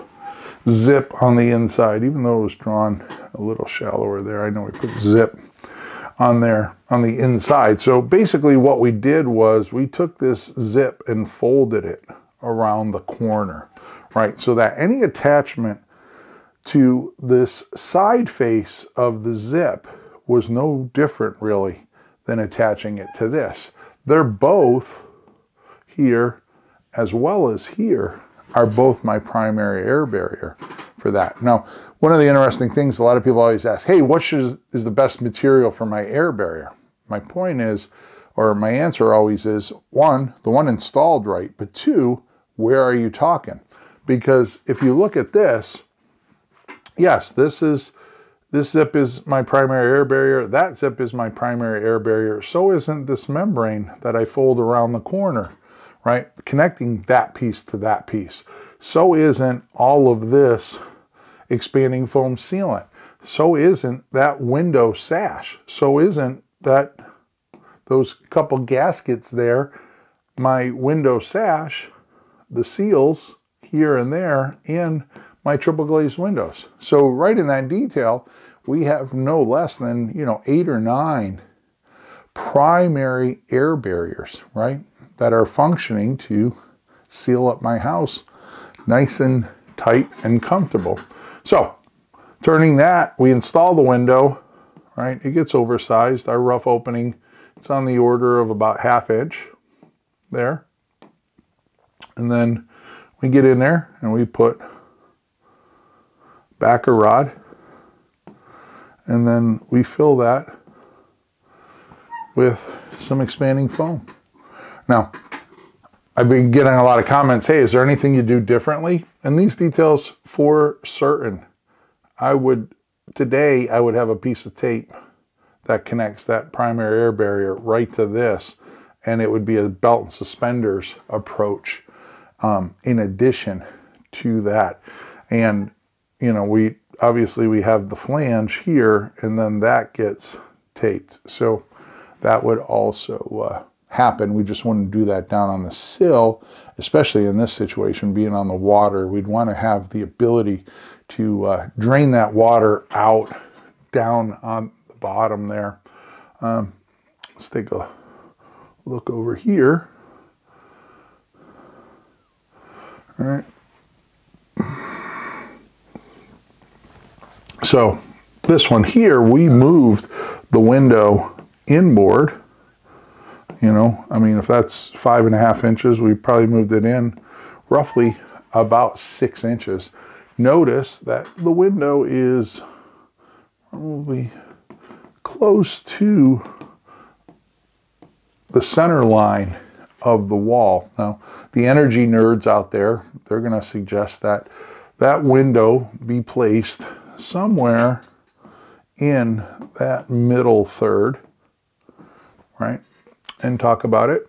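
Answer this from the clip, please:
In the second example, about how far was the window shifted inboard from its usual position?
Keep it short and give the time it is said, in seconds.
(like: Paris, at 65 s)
6 inches, at 178 s.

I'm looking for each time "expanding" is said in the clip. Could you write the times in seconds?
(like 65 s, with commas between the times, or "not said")
61 s, 113 s.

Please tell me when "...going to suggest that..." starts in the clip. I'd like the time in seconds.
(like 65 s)
193 s.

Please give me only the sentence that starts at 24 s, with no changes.
They're both here as well as here are both my primary air barrier for that.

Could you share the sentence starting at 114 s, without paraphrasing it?
Now, I've been getting a lot of comments.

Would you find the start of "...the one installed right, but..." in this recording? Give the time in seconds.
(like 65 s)
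40 s.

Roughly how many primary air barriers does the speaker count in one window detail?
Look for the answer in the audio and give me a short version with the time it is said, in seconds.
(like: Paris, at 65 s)
8 or 9, at 80 s.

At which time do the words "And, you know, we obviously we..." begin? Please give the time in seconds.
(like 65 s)
135 s.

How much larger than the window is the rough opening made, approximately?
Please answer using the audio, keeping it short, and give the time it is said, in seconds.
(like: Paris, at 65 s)
half inch, at 98 s.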